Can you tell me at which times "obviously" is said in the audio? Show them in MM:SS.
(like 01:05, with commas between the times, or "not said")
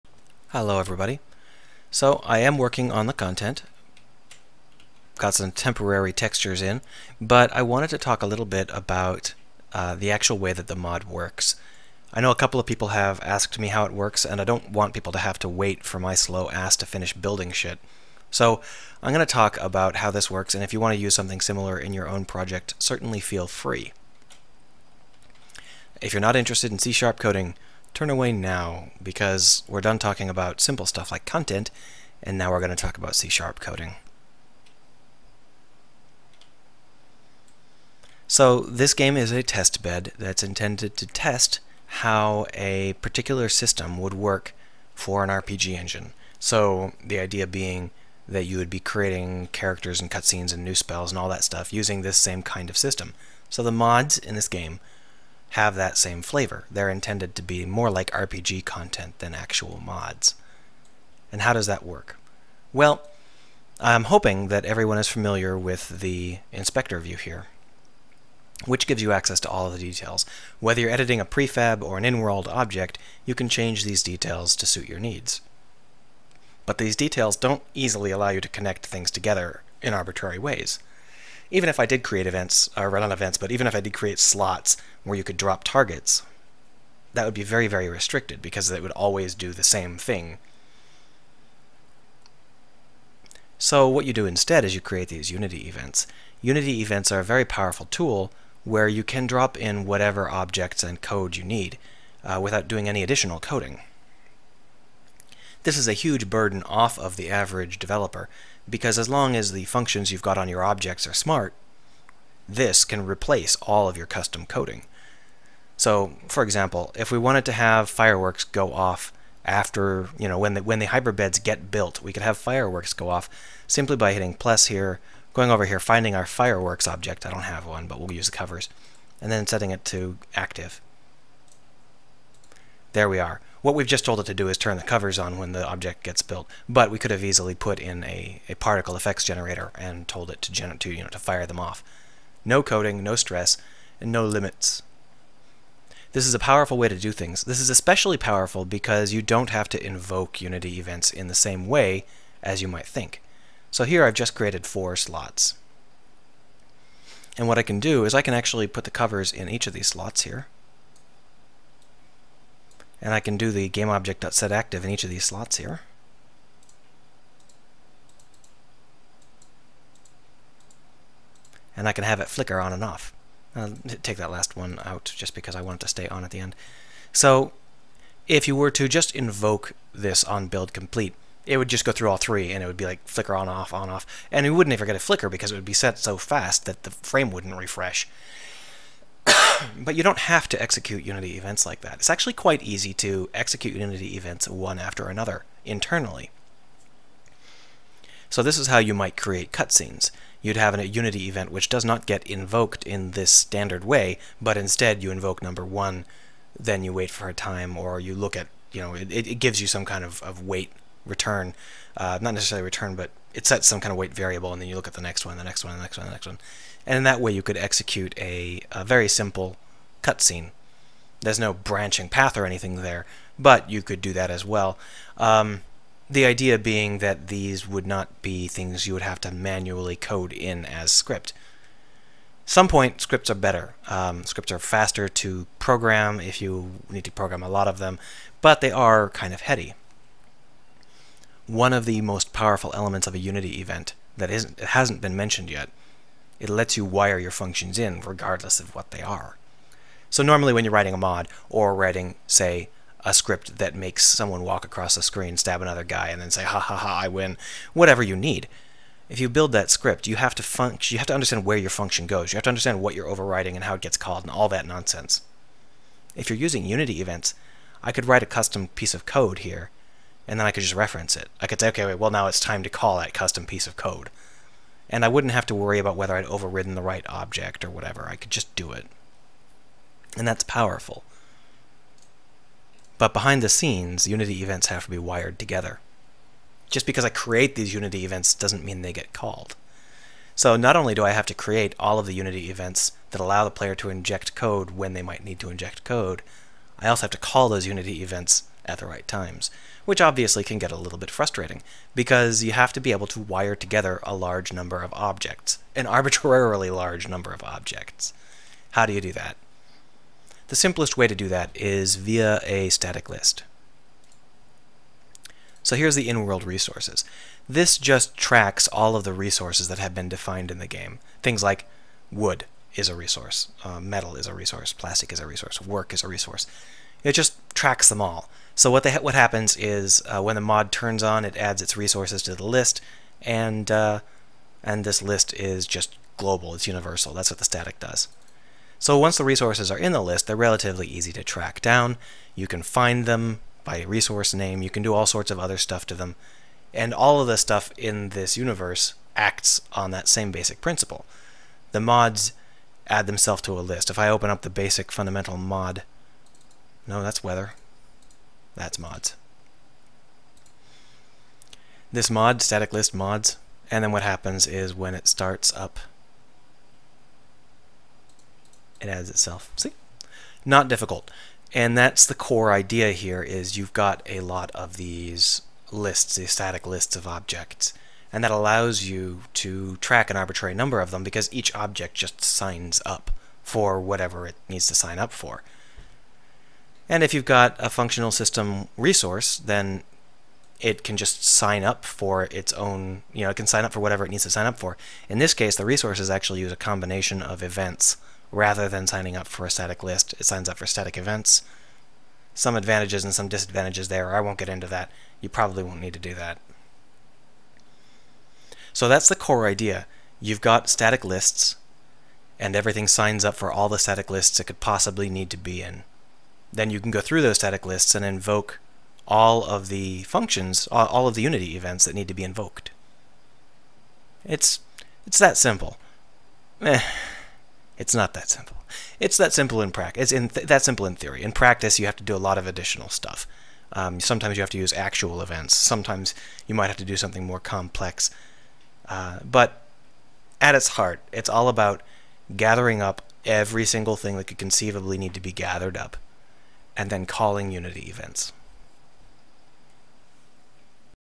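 05:00.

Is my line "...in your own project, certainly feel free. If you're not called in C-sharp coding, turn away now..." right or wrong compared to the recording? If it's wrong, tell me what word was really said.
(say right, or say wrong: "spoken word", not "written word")
wrong: "interested", not "called".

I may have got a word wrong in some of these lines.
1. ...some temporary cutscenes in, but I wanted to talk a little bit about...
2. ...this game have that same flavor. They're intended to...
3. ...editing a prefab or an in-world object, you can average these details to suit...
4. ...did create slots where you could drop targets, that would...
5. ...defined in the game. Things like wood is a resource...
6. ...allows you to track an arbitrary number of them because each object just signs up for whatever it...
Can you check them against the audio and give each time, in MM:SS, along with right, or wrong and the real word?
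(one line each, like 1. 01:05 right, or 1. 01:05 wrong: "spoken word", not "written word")
1. 00:05 wrong: "textures", not "cutscenes"
2. 00:54 right
3. 01:10 wrong: "change", not "average"
4. 01:23 right
5. 05:20 right
6. 06:18 right.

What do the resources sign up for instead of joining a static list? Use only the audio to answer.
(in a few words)
static events.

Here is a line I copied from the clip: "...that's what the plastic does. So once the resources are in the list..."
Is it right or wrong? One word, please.
wrong.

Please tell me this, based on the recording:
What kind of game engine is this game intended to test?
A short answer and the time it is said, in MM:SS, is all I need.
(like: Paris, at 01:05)
RPG engine, at 00:45.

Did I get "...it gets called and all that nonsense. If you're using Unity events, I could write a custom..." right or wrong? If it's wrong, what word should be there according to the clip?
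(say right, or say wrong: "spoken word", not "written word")
right.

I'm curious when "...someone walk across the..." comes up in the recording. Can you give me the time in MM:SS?
04:14.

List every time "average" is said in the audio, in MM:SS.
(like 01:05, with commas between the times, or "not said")
01:47.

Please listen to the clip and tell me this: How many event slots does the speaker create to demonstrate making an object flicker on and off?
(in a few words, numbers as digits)
4.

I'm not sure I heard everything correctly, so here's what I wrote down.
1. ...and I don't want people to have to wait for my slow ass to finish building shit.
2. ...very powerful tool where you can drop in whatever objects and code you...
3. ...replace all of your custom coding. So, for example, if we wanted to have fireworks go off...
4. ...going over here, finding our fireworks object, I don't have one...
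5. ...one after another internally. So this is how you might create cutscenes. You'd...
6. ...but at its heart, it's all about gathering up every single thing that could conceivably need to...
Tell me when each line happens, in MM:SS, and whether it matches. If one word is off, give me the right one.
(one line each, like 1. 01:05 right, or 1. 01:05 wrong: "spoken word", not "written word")
1. 00:14 right
2. 01:37 right
3. 01:53 right
4. 02:05 right
5. 03:14 right
6. 07:19 right.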